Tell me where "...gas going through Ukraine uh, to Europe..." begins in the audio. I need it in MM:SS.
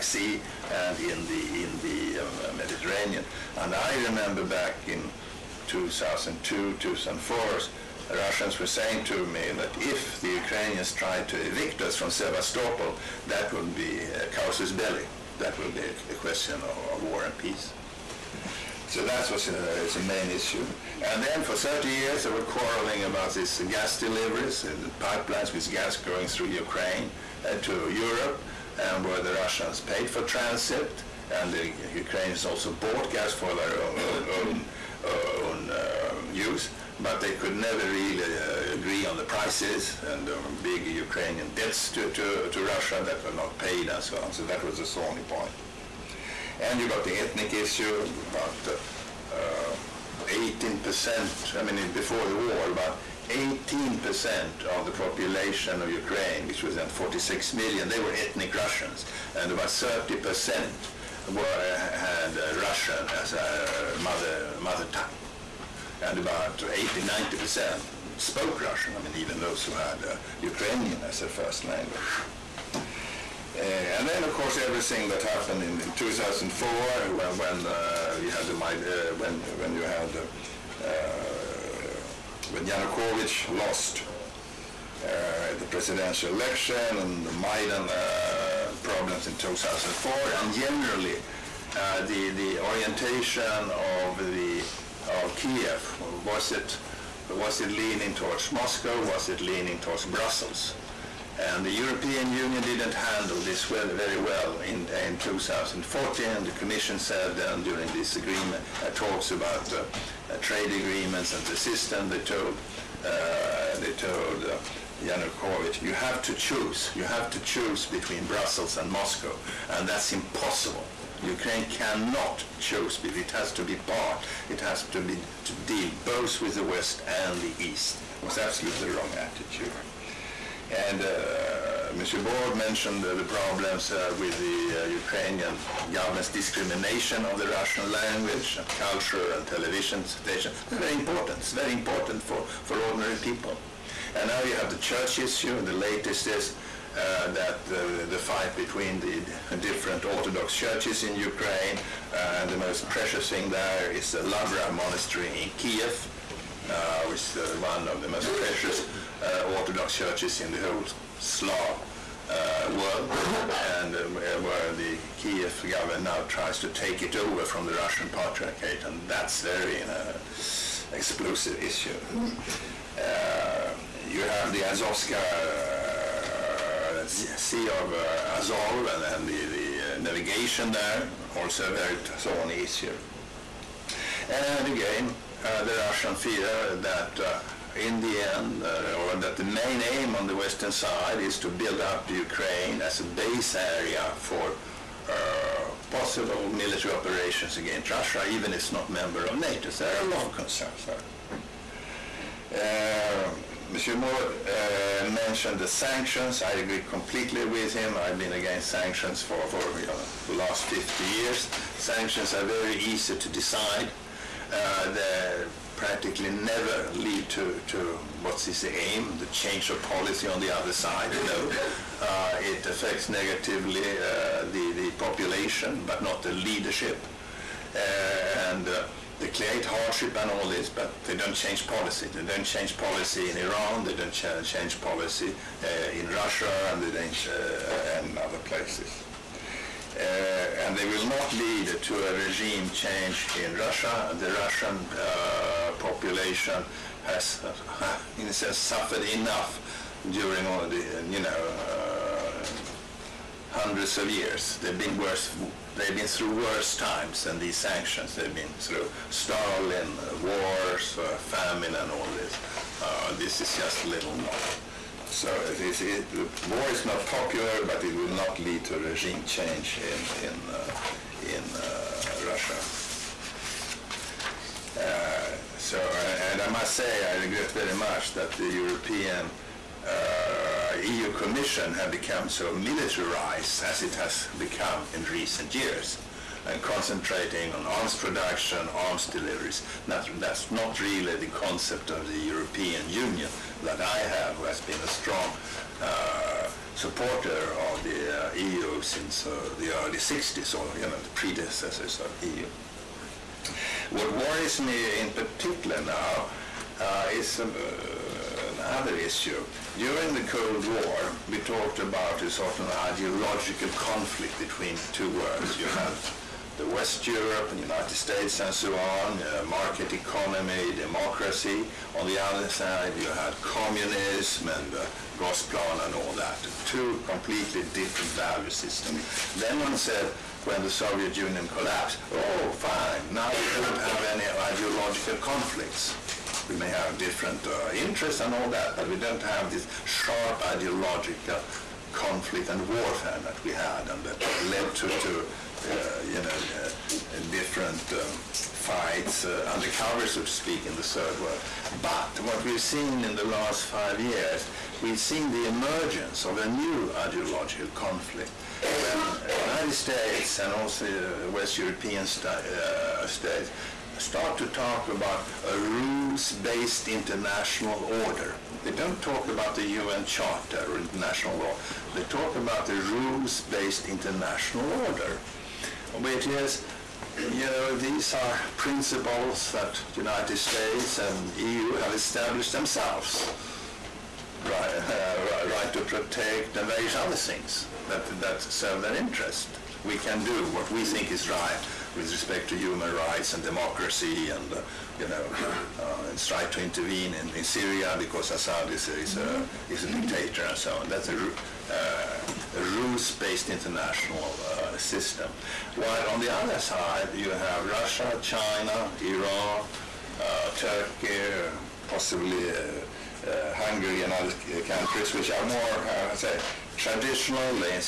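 00:25.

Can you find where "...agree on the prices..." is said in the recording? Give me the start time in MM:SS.
00:38.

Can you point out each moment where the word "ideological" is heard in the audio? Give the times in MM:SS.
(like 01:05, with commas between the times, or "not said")
05:12, 05:34, 05:40, 05:56.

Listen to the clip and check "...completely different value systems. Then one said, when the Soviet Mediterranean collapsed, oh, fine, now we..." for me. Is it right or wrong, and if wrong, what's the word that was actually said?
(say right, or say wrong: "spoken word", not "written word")
wrong: "Union", not "Mediterranean".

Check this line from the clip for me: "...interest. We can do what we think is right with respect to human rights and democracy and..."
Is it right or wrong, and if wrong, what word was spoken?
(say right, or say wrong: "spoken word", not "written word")
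right.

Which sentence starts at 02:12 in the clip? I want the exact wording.
Borg mentioned uh, the problems uh, with the uh, Ukrainian government's discrimination of the Russian language, and culture, and television stations.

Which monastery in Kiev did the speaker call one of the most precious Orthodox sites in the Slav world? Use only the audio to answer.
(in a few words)
Lavra Monastery.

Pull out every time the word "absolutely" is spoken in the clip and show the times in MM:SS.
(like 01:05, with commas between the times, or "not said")
02:08.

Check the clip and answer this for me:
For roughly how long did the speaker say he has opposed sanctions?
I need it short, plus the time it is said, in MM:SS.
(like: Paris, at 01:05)
50 years, at 03:30.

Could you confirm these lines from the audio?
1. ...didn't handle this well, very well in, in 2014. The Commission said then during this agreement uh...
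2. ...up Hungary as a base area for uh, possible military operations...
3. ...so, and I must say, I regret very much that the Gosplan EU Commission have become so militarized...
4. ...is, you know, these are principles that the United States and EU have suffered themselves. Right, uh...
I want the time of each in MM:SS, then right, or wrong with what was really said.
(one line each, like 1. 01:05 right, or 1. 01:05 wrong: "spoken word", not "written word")
1. 01:42 right
2. 03:11 wrong: "Ukraine", not "Hungary"
3. 04:35 wrong: "European", not "Gosplan"
4. 06:16 wrong: "established", not "suffered".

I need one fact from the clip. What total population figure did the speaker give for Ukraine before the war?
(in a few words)
46 million.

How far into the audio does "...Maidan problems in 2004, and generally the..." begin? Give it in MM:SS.
01:27.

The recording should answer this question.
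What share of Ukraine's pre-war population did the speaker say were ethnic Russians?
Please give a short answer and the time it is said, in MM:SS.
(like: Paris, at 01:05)
18%, at 00:52.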